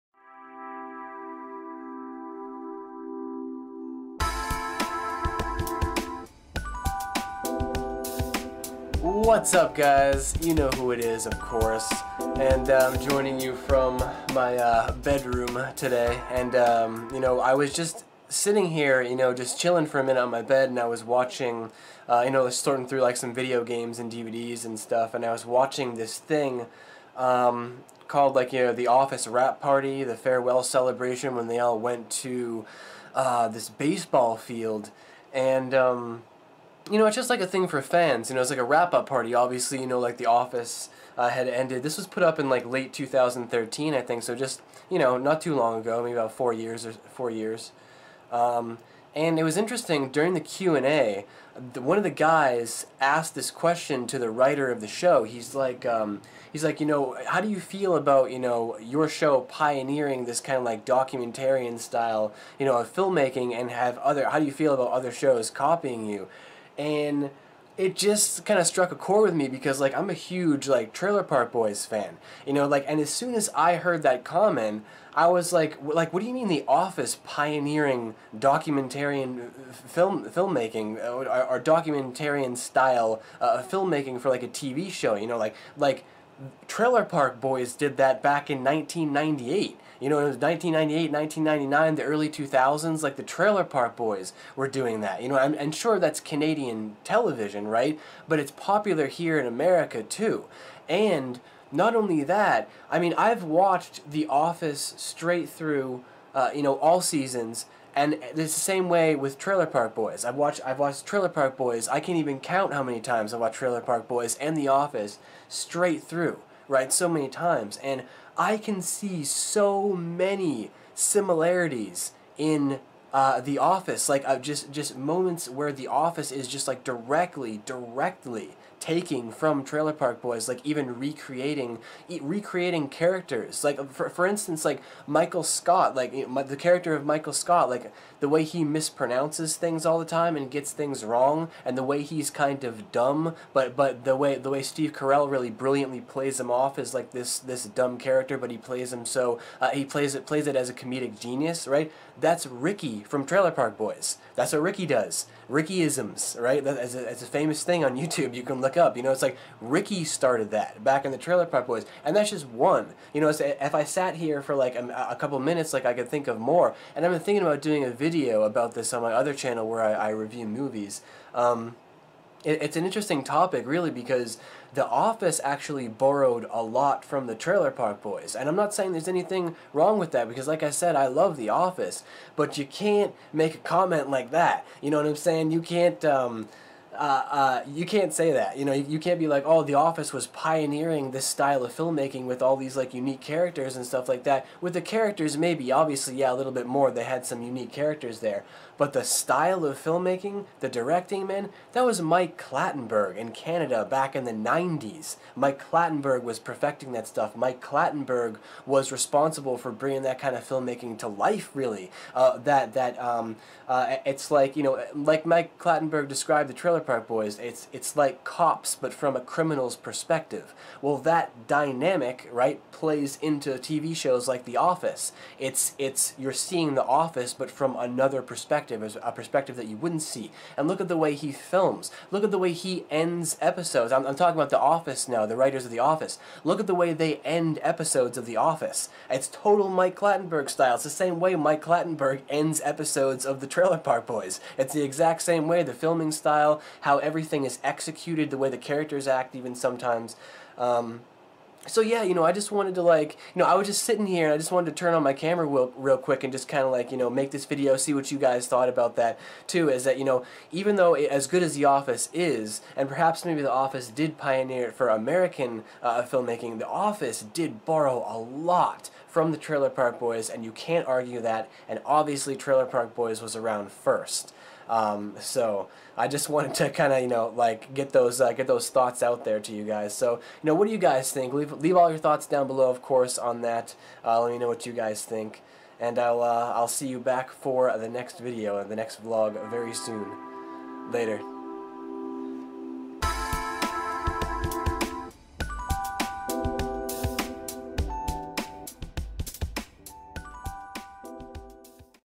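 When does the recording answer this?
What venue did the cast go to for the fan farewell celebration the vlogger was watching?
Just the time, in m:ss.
0:33.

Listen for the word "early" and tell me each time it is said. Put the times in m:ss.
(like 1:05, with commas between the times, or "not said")
1:32.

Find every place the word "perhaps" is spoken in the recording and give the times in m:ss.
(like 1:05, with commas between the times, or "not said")
4:22.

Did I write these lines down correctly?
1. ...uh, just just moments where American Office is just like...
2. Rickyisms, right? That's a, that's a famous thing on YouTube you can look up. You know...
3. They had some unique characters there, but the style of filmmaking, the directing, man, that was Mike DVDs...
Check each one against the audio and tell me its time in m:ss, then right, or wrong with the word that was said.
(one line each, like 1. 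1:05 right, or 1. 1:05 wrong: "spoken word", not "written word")
1. 2:04 wrong: "The", not "American"
2. 2:35 right
3. 3:16 wrong: "Clattenburg", not "DVDs".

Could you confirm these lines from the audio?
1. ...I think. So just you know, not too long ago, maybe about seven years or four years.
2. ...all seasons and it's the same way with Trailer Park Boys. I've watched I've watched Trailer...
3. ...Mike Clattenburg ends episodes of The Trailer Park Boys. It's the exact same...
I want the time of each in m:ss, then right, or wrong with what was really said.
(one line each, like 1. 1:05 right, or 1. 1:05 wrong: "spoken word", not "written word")
1. 0:43 wrong: "four", not "seven"
2. 1:46 right
3. 4:01 right.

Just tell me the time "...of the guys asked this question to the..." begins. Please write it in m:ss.
0:51.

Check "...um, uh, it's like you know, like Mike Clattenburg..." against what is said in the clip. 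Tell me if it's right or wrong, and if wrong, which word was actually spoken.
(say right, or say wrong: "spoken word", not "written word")
right.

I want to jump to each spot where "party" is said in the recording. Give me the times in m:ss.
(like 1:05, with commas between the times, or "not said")
0:29, 0:39.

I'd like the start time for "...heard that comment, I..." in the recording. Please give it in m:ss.
1:13.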